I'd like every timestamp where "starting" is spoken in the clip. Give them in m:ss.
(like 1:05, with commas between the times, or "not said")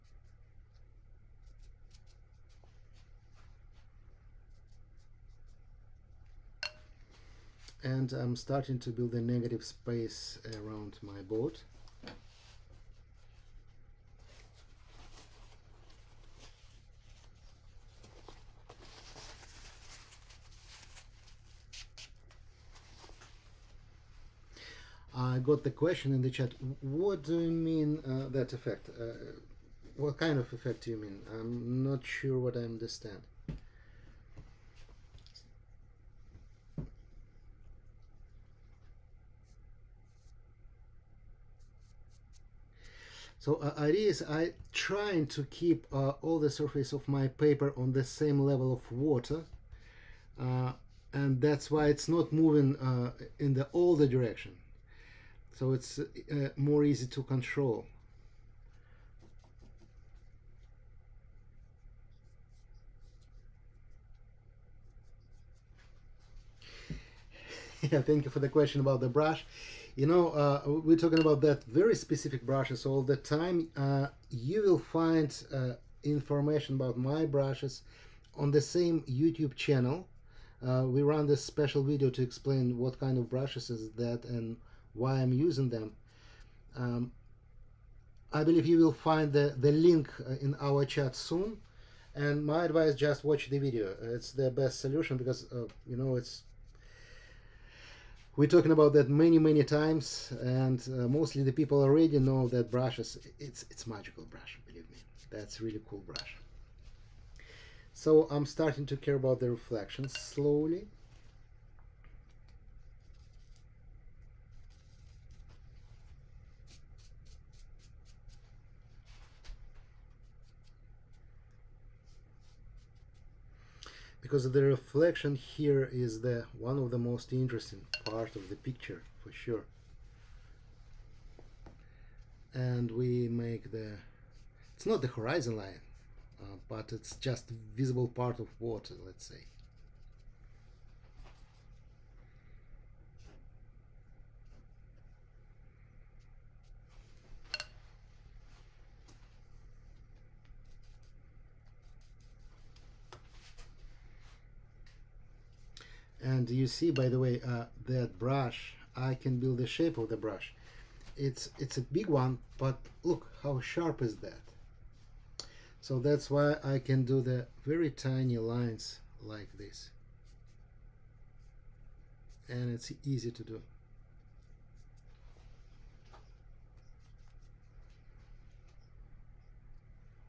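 0:08, 1:48.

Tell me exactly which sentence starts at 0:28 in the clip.
Uh, what kind of effect do you mean?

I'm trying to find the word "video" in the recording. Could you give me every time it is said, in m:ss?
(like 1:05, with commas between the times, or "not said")
1:21, 1:33.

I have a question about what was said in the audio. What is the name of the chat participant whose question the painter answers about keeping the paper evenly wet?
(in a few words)
Iris.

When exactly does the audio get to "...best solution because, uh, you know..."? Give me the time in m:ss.
1:34.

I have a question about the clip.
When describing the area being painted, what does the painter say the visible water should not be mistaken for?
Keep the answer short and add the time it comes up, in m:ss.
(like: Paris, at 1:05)
the horizon line, at 2:15.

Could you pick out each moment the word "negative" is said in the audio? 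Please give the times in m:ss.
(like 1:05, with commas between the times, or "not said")
0:09.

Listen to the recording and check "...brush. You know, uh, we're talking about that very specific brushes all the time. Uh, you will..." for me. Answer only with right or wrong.
right.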